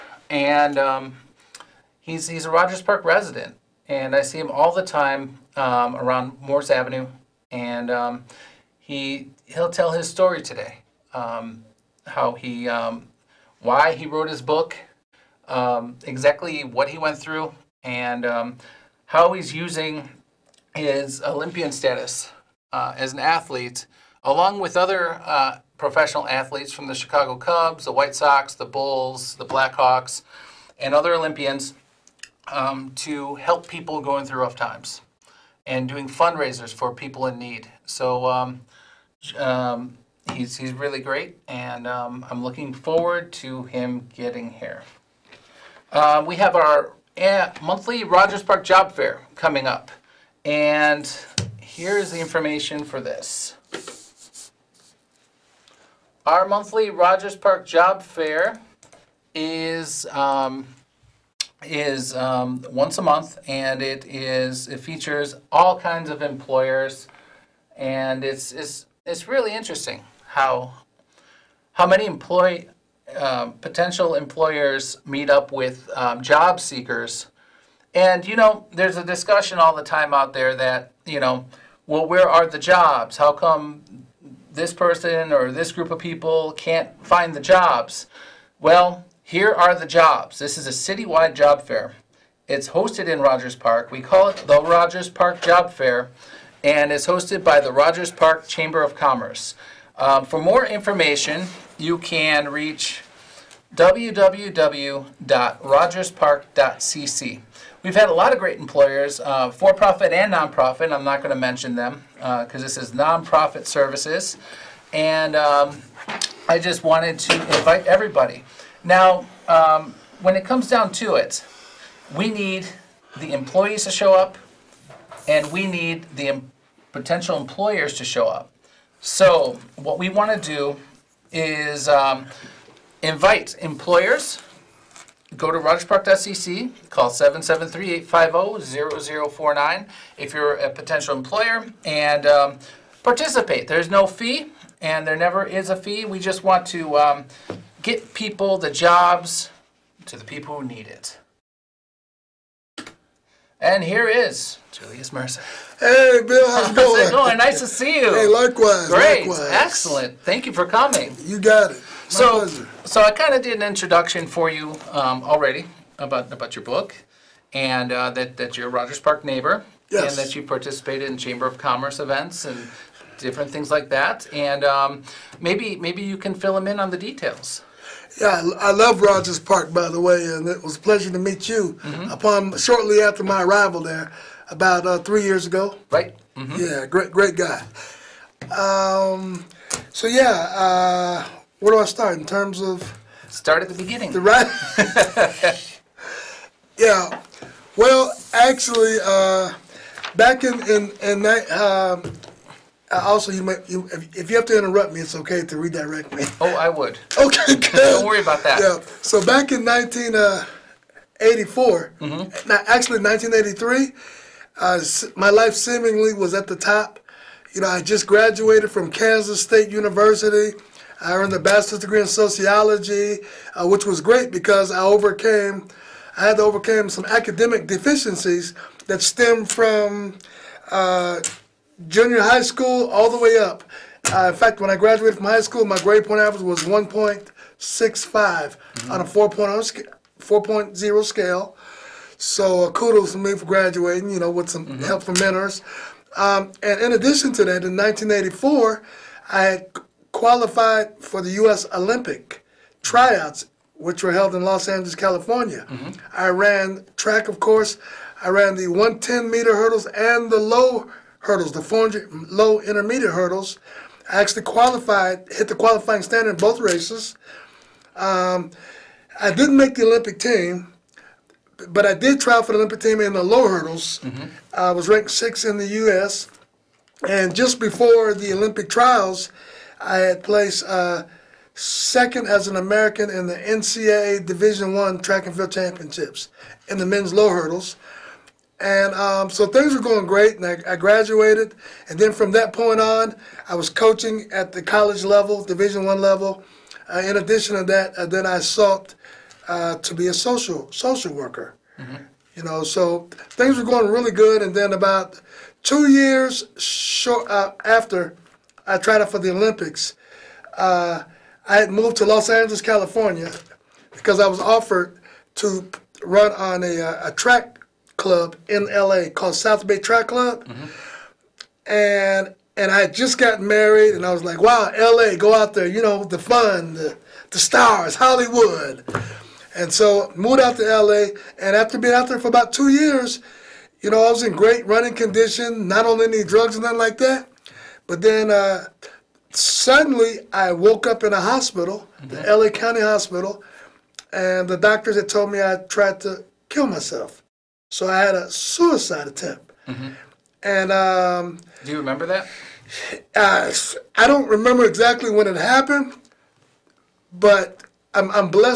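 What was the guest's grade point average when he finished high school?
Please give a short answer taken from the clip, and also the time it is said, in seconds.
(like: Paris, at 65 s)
1.65, at 236 s.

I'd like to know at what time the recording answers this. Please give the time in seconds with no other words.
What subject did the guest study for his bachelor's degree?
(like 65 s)
222 s.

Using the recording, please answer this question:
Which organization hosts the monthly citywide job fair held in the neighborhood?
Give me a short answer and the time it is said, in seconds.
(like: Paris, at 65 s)
Rogers Park Chamber of Commerce, at 97 s.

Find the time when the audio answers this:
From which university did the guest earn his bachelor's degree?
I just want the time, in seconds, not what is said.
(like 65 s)
218 s.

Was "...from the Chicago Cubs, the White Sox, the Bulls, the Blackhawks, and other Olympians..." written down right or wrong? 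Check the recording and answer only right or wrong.
right.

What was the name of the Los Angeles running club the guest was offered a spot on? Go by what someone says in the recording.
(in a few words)
South Bay Track Club.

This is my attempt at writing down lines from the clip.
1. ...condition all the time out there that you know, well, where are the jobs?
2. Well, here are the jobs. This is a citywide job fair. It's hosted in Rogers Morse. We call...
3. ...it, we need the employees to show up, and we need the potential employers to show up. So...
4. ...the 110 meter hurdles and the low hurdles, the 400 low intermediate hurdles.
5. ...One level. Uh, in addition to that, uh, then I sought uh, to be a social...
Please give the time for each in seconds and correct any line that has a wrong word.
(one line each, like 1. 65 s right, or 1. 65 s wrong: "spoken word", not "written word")
1. 79 s wrong: "discussion", not "condition"
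2. 88 s wrong: "Park", not "Morse"
3. 121 s right
4. 258 s right
5. 295 s right.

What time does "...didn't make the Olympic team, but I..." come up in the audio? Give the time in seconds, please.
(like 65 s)
269 s.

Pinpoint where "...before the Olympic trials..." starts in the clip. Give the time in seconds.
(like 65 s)
277 s.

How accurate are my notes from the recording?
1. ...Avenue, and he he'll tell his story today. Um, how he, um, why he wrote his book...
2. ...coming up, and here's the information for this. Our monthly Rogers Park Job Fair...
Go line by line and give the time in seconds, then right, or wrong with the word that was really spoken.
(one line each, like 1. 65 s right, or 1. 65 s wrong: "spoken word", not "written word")
1. 6 s right
2. 49 s right.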